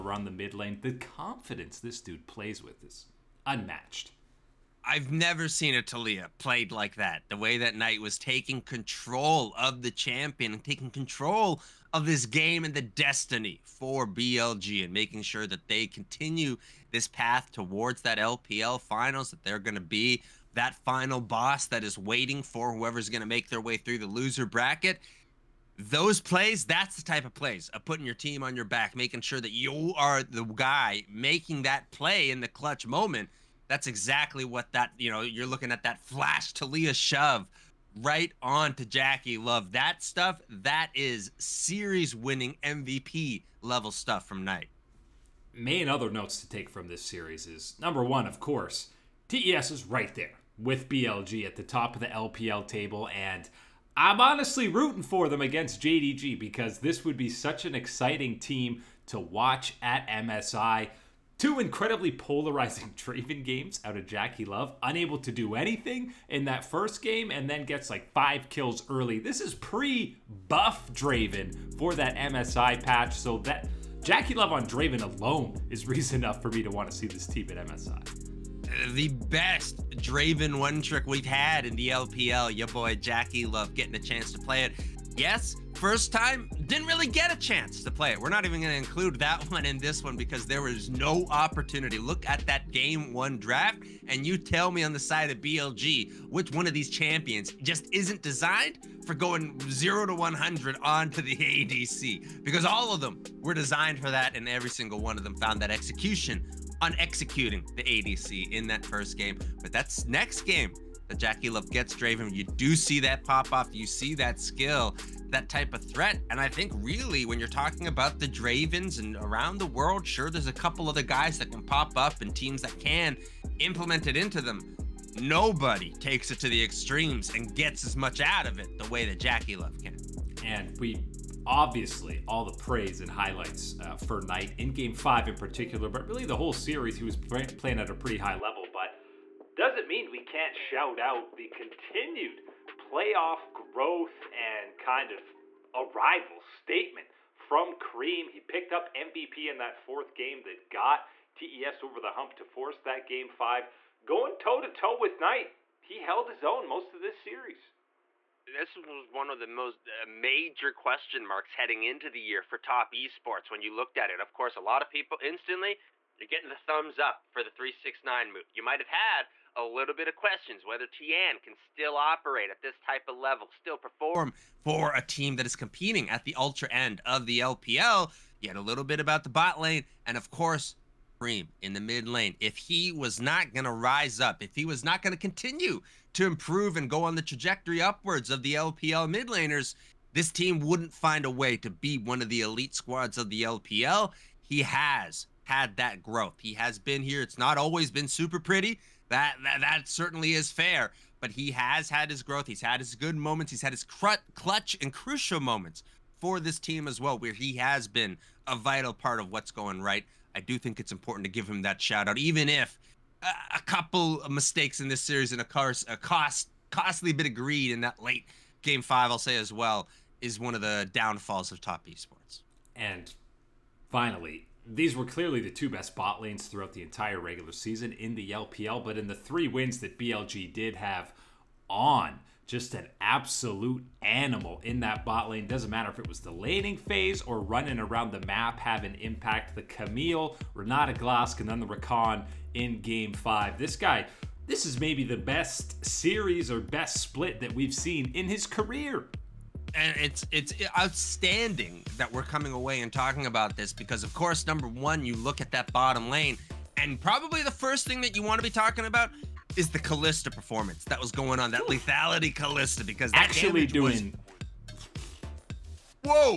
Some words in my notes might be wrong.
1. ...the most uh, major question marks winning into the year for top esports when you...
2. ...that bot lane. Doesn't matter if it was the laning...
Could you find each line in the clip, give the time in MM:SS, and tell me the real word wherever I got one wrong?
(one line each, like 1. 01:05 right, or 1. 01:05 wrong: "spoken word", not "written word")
1. 02:39 wrong: "heading", not "winning"
2. 03:54 right.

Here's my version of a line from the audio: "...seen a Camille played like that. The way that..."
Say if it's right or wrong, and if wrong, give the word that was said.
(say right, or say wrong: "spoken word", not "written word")
wrong: "Taliyah", not "Camille".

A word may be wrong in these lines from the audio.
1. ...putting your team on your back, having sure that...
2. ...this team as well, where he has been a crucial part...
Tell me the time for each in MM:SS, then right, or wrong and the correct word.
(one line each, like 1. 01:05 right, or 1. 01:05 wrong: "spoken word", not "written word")
1. 00:27 wrong: "making", not "having"
2. 03:26 wrong: "vital", not "crucial".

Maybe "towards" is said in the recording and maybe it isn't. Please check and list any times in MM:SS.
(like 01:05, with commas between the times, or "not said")
00:17.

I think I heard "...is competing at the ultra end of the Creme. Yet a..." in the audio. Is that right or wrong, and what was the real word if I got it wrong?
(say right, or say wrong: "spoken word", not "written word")
wrong: "LPL", not "Creme".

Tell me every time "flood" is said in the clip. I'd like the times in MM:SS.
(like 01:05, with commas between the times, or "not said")
not said.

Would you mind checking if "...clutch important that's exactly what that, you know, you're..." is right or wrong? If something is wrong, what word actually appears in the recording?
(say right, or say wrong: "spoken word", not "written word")
wrong: "moment", not "important".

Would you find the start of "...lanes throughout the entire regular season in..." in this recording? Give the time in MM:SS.
03:46.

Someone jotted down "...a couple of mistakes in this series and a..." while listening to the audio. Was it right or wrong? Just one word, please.
right.